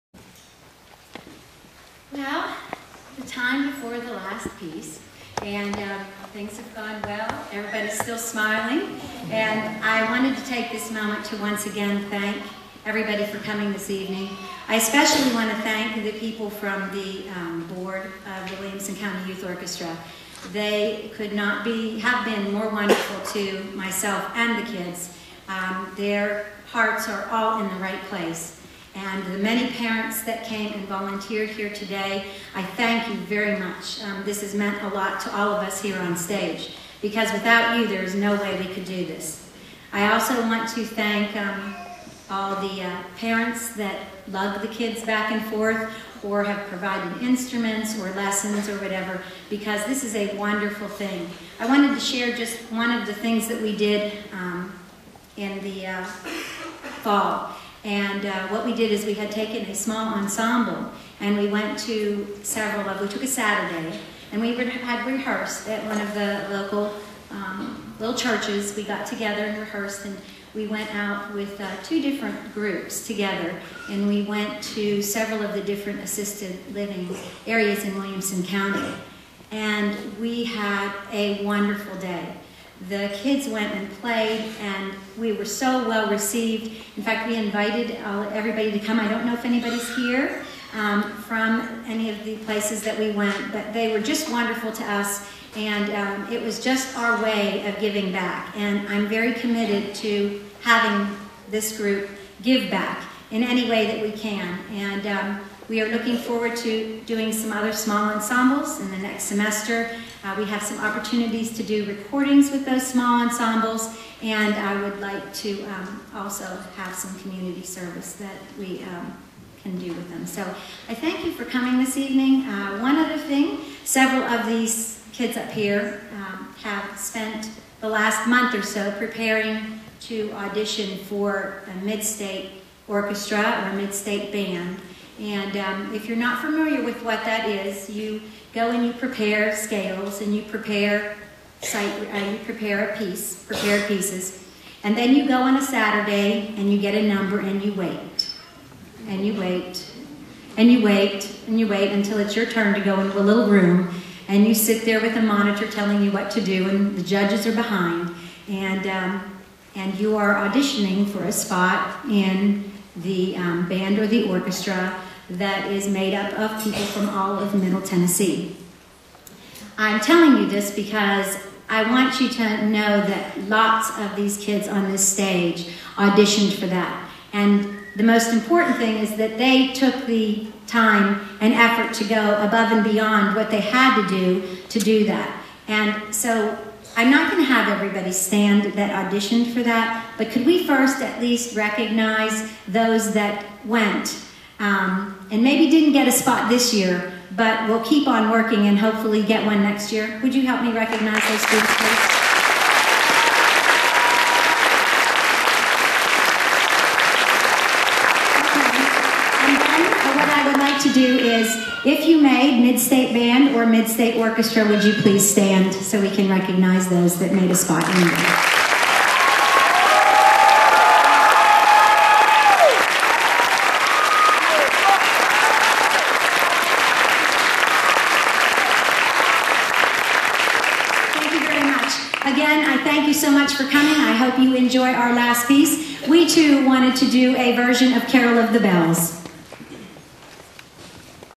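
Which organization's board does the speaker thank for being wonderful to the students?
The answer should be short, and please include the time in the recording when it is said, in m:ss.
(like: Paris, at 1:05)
Williamson County Youth Orchestra, at 0:18.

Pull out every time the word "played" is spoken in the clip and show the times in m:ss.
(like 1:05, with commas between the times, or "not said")
1:24.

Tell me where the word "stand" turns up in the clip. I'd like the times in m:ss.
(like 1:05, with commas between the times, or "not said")
3:08, 3:35.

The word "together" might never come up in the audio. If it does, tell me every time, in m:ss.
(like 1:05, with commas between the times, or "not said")
1:09, 1:13.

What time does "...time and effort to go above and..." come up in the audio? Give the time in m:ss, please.
3:00.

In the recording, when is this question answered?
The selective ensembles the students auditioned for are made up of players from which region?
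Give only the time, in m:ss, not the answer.
2:47.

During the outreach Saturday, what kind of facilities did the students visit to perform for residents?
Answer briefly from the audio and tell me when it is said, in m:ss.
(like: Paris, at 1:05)
Assisted living areas, at 1:16.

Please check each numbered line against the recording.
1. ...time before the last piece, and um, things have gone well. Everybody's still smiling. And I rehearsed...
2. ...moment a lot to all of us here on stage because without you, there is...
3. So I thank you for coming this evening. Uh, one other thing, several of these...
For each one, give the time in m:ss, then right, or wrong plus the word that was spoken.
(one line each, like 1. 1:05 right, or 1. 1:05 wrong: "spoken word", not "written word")
1. 0:03 wrong: "wanted", not "rehearsed"
2. 0:34 wrong: "meant", not "moment"
3. 2:00 right.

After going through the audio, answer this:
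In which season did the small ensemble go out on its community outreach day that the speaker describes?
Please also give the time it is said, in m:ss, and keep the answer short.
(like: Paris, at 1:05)
Fall, at 0:57.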